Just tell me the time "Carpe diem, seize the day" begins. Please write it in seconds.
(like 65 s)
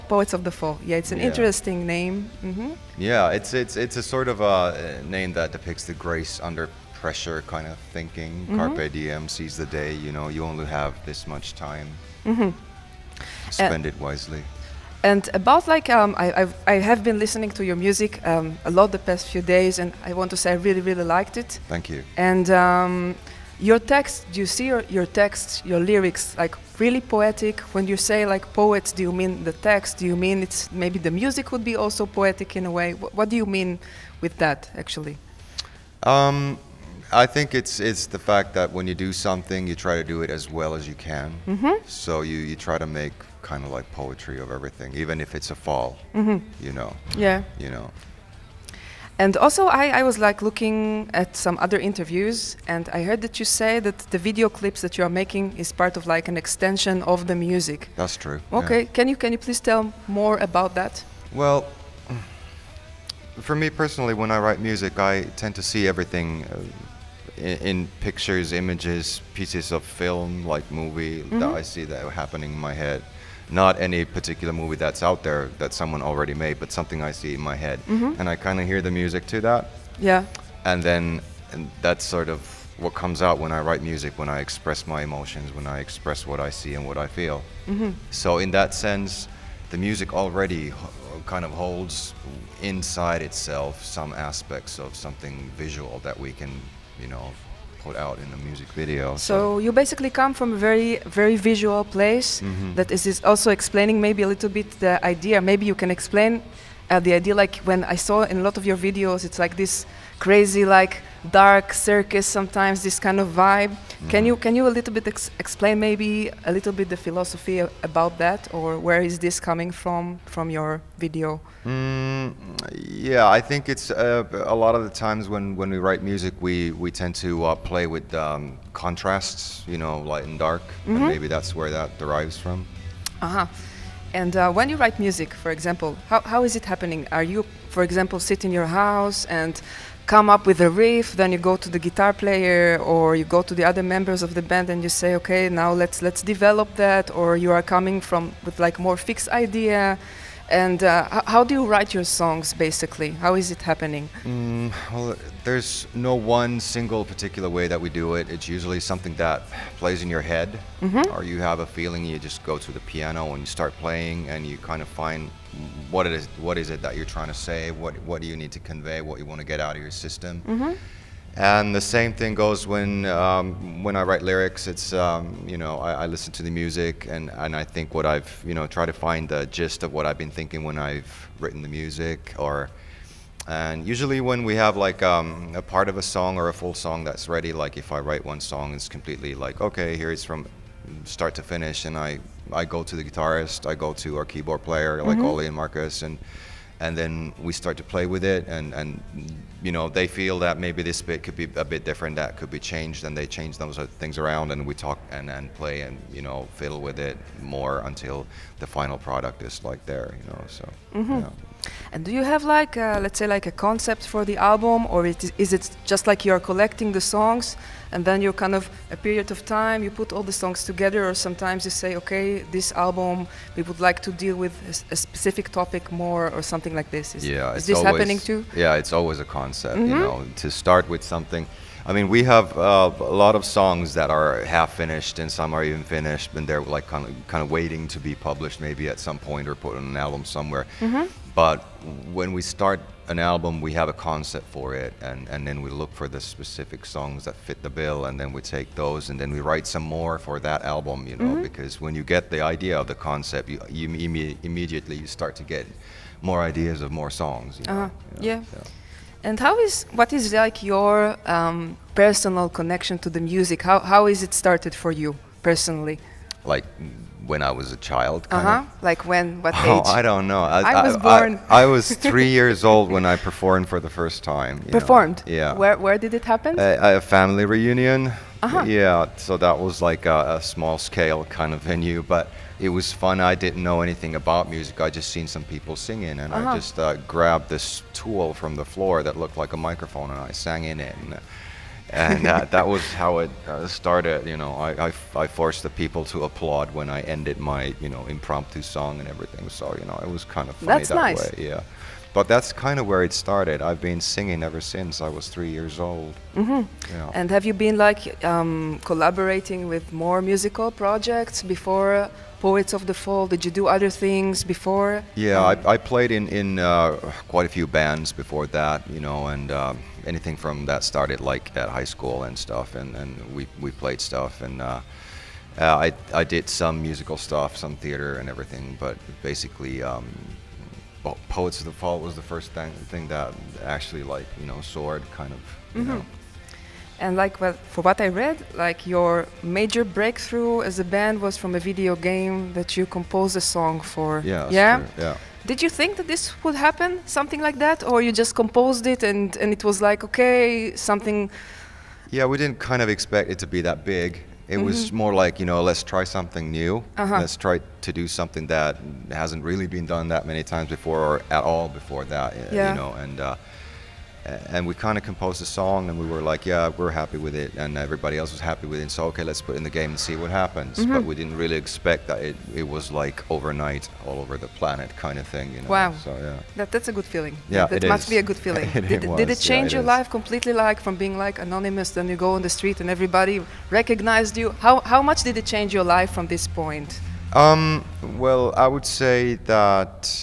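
8 s.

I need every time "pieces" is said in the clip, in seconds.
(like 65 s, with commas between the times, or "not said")
69 s.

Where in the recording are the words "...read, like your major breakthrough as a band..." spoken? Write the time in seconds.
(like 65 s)
338 s.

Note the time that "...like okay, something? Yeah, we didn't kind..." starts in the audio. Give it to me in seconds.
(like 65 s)
349 s.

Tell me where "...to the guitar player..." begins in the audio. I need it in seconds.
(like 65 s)
141 s.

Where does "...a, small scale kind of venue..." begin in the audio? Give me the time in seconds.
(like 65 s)
280 s.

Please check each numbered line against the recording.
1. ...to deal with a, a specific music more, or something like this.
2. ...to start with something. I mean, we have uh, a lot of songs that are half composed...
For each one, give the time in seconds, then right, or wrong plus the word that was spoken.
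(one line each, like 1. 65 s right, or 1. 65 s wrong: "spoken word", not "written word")
1. 223 s wrong: "topic", not "music"
2. 230 s wrong: "finished", not "composed".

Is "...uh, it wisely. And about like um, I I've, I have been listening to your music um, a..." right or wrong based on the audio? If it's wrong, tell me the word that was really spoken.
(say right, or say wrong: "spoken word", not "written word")
right.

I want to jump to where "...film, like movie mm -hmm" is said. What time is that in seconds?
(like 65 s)
69 s.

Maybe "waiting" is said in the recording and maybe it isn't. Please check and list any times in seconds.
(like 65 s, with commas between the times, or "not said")
237 s.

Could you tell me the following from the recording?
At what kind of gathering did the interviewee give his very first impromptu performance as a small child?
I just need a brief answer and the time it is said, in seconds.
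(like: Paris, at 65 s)
A family reunion, at 276 s.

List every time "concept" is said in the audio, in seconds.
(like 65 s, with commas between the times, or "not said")
213 s, 229 s, 243 s, 252 s.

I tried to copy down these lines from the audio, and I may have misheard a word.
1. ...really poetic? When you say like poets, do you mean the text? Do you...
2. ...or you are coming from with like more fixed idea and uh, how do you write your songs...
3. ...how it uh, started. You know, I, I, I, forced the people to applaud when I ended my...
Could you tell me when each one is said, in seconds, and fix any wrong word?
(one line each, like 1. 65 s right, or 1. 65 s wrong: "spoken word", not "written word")
1. 26 s right
2. 147 s right
3. 292 s right.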